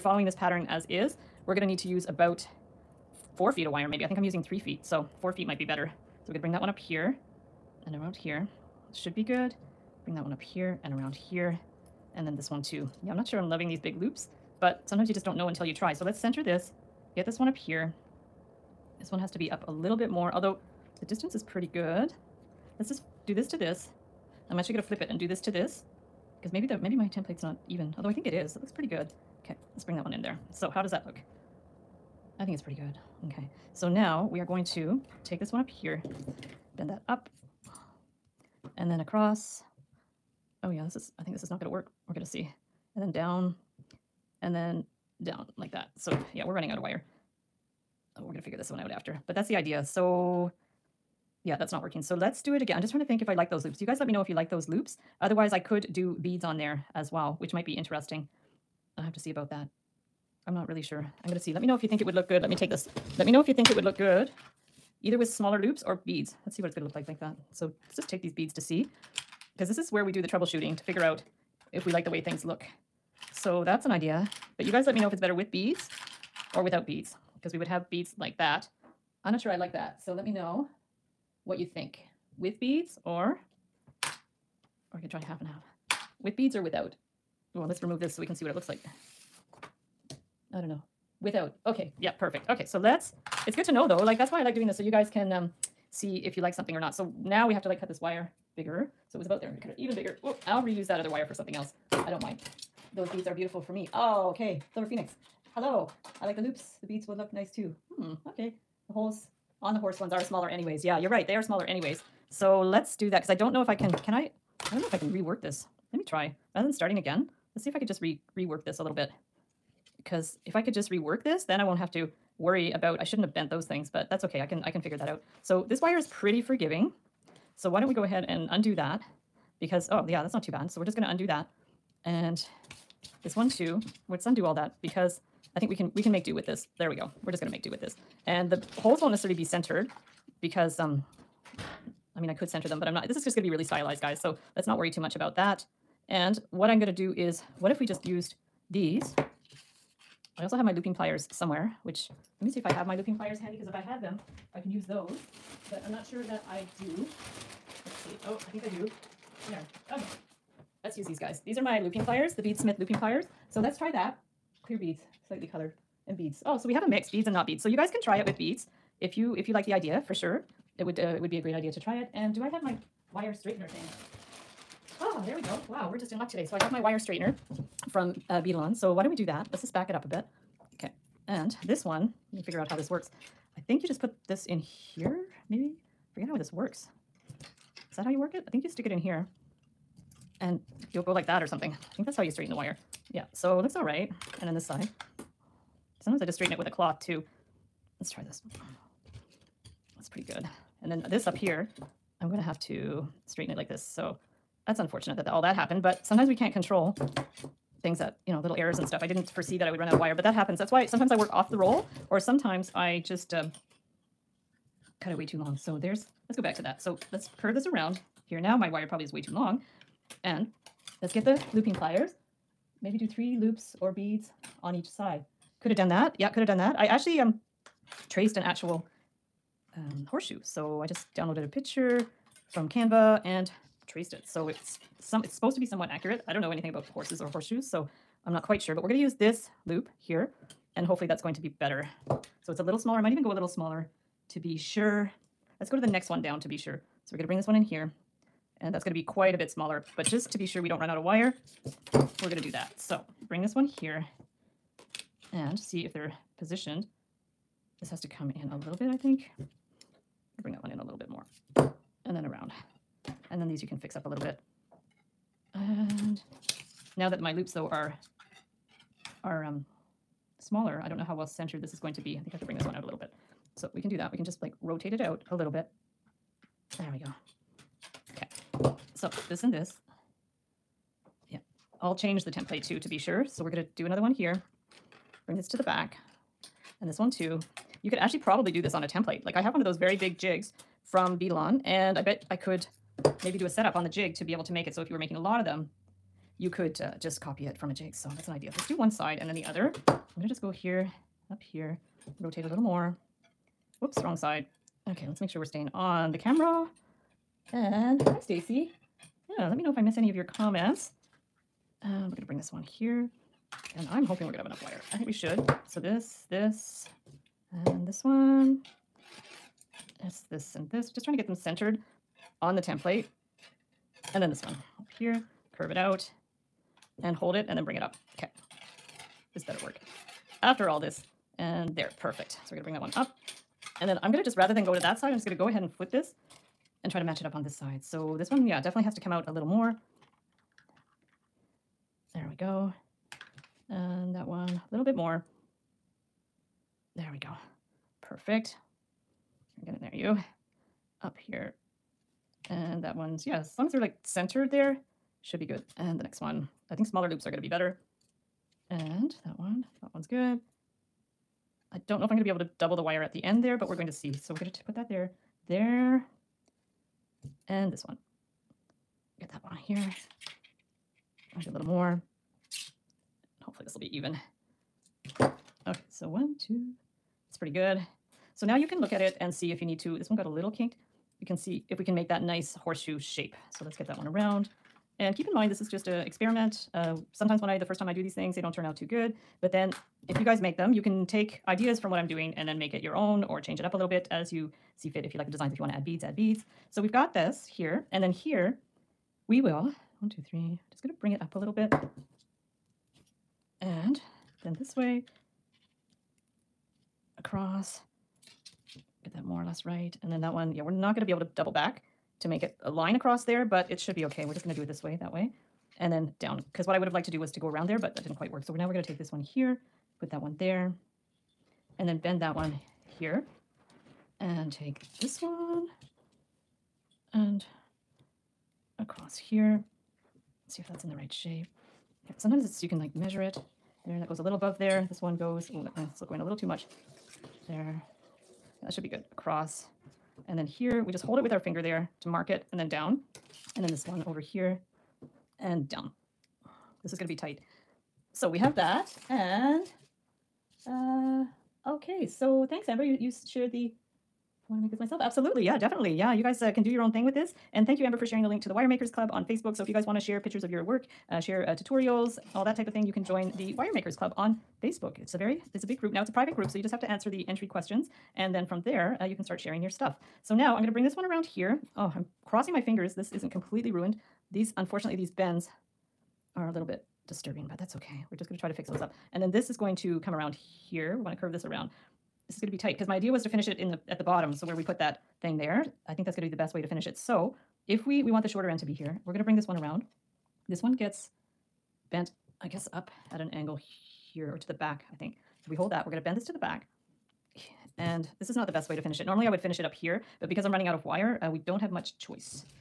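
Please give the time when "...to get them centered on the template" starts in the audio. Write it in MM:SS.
05:21.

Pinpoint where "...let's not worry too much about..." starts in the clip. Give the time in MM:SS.
02:24.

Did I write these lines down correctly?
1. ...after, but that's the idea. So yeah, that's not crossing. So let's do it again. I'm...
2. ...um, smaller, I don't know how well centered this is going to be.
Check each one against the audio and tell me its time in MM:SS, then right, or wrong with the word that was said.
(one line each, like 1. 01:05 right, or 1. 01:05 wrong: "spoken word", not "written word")
1. 00:48 wrong: "working", not "crossing"
2. 04:29 right.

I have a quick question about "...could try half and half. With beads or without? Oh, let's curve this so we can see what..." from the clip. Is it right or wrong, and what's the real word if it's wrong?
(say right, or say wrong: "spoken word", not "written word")
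wrong: "remove", not "curve".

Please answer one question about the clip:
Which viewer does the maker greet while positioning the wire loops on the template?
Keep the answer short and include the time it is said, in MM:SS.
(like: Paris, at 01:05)
Stacy, at 05:08.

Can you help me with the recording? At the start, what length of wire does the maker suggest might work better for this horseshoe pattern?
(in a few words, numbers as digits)
4 feet.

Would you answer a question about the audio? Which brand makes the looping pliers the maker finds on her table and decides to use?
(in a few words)
Beadsmith.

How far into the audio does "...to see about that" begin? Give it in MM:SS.
00:59.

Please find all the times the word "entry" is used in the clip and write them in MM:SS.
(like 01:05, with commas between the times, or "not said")
07:47.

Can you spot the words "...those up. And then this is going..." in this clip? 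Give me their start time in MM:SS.
07:58.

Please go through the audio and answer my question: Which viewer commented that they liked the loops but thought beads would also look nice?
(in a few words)
Silver Phoenix.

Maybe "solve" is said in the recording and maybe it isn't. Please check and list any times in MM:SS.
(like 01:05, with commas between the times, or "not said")
not said.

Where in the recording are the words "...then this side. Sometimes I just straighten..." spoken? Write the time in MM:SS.
03:14.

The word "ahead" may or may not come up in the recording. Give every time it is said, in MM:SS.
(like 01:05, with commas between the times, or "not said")
02:08, 05:35.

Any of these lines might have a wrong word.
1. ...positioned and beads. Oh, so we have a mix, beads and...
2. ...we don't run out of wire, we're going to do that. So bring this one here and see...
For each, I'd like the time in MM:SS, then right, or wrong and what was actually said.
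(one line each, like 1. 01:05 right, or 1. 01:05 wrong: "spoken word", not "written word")
1. 02:45 wrong: "colored", not "positioned"
2. 04:10 right.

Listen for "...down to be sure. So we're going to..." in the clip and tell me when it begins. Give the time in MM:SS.
04:06.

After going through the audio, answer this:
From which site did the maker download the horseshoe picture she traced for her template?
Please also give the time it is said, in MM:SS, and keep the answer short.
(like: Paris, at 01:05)
Canva, at 03:52.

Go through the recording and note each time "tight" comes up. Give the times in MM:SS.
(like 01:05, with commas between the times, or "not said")
07:27, 08:02.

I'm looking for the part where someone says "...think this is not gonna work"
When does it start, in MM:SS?
00:41.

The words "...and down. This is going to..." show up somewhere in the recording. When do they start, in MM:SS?
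07:25.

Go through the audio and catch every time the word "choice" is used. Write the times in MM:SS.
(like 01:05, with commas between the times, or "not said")
08:21.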